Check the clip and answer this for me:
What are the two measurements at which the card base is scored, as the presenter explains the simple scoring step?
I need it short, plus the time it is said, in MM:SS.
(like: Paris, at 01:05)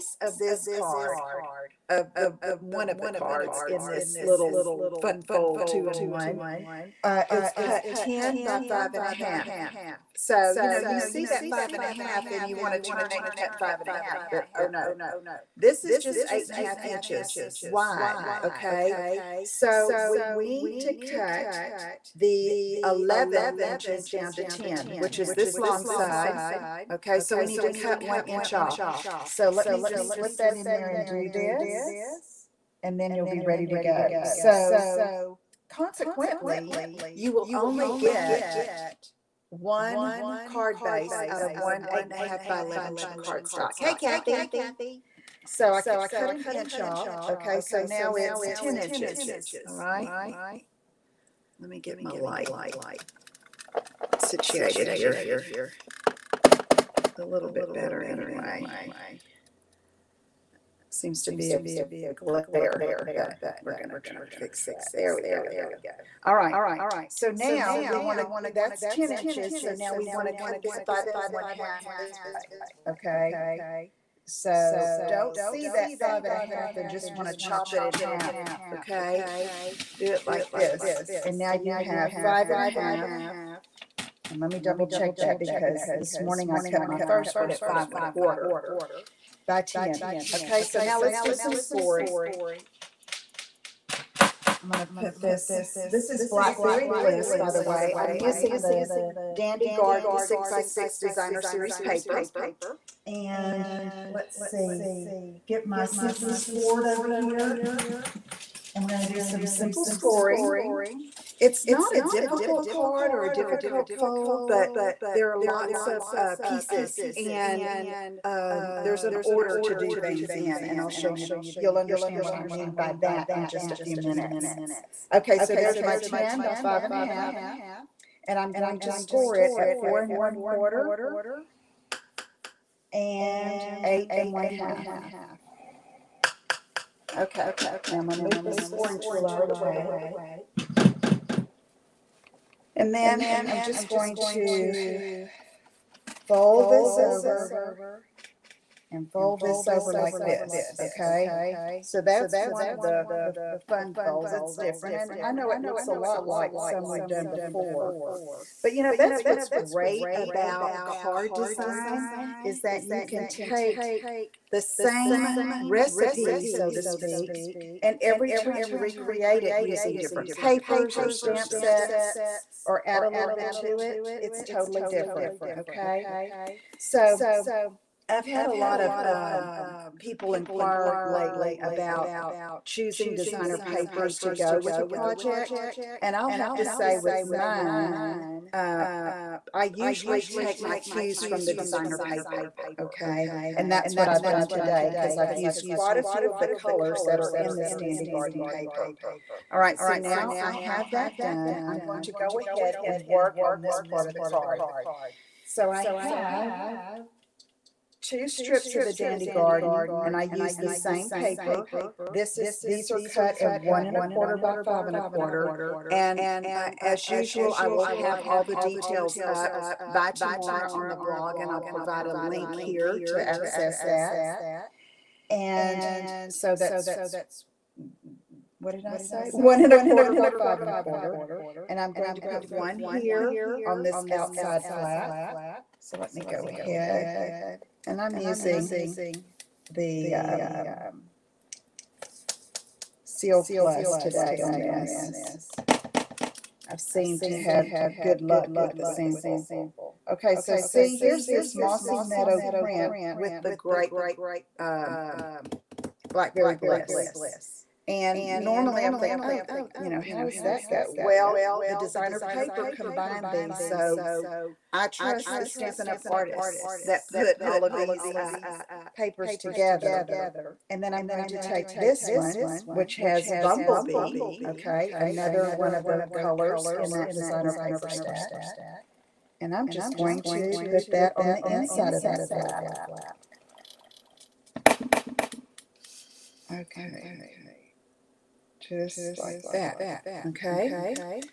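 4 1/4 and 8 1/2, at 02:09.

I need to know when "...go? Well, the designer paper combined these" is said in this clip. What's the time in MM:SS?
04:20.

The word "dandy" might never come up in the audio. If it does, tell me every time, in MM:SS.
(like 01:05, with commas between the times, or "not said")
01:39, 03:17, 03:28.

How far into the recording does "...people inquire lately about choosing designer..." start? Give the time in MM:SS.
02:59.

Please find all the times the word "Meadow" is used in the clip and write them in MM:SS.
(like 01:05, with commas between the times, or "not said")
04:11.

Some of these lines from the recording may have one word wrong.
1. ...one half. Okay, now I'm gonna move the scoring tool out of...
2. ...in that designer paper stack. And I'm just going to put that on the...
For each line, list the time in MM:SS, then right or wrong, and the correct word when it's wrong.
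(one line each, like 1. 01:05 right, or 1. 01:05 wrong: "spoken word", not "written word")
1. 02:14 right
2. 04:36 right.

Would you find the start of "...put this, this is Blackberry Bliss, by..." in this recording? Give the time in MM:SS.
01:34.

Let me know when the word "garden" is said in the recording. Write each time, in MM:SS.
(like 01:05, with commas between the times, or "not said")
01:39, 03:18, 03:29.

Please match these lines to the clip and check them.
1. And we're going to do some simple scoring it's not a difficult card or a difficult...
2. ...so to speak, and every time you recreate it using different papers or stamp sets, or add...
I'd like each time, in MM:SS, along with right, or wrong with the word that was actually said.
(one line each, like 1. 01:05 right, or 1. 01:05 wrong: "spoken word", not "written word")
1. 01:48 right
2. 02:46 right.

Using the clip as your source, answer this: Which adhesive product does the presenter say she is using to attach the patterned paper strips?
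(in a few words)
Seal Plus.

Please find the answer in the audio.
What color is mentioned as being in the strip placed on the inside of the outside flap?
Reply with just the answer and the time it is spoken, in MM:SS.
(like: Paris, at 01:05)
Bumblebee, at 04:33.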